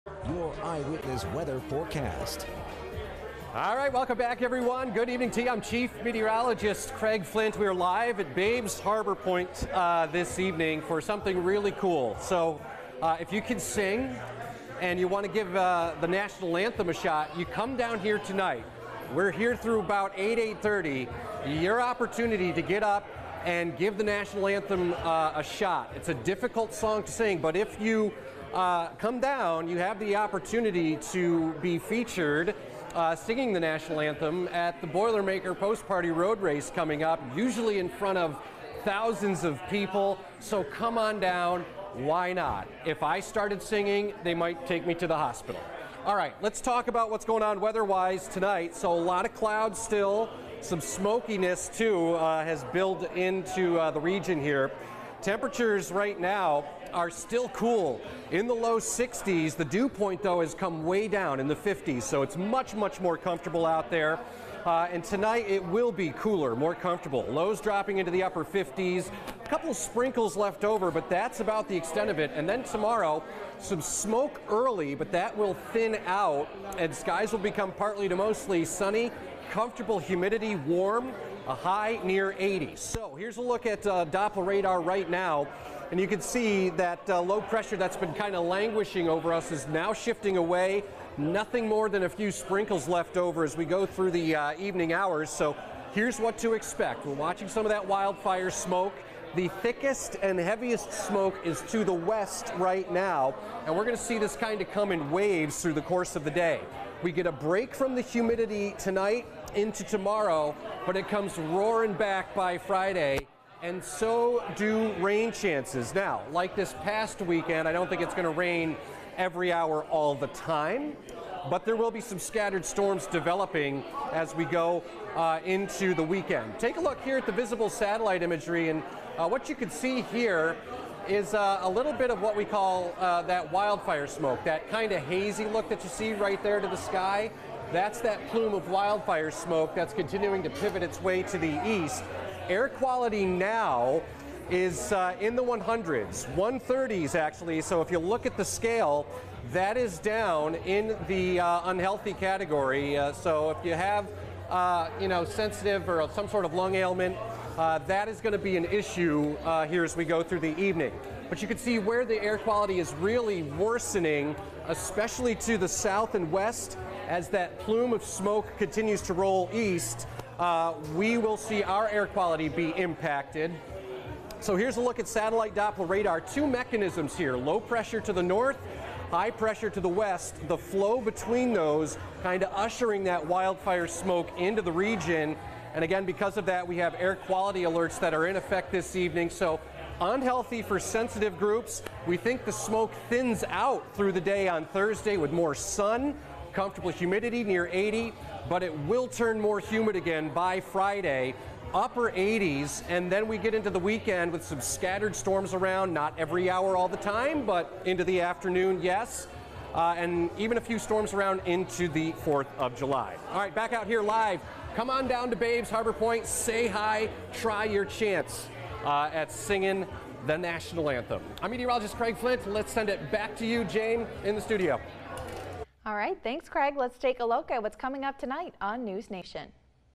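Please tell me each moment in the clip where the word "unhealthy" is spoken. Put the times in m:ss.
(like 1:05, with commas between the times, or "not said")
2:31, 3:10.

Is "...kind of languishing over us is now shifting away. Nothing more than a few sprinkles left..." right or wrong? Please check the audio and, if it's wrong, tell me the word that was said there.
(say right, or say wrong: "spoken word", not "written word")
right.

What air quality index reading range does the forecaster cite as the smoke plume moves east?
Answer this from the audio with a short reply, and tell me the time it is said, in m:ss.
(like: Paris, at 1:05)
130s, at 2:26.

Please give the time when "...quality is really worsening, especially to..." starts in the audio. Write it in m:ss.
2:42.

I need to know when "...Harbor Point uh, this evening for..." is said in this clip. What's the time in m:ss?
0:08.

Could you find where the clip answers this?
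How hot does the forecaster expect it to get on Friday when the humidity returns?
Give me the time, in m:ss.
3:21.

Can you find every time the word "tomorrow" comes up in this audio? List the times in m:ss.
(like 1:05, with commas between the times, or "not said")
1:12, 1:49.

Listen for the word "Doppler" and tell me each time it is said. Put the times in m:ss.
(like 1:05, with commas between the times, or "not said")
1:24, 2:55.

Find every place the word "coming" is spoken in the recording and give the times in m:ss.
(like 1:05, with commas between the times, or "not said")
0:36, 3:47.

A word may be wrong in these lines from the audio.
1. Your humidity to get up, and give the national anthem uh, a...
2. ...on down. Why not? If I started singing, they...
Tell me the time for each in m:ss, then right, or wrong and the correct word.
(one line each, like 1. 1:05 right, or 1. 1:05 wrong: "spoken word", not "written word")
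1. 0:21 wrong: "opportunity", not "humidity"
2. 0:40 right.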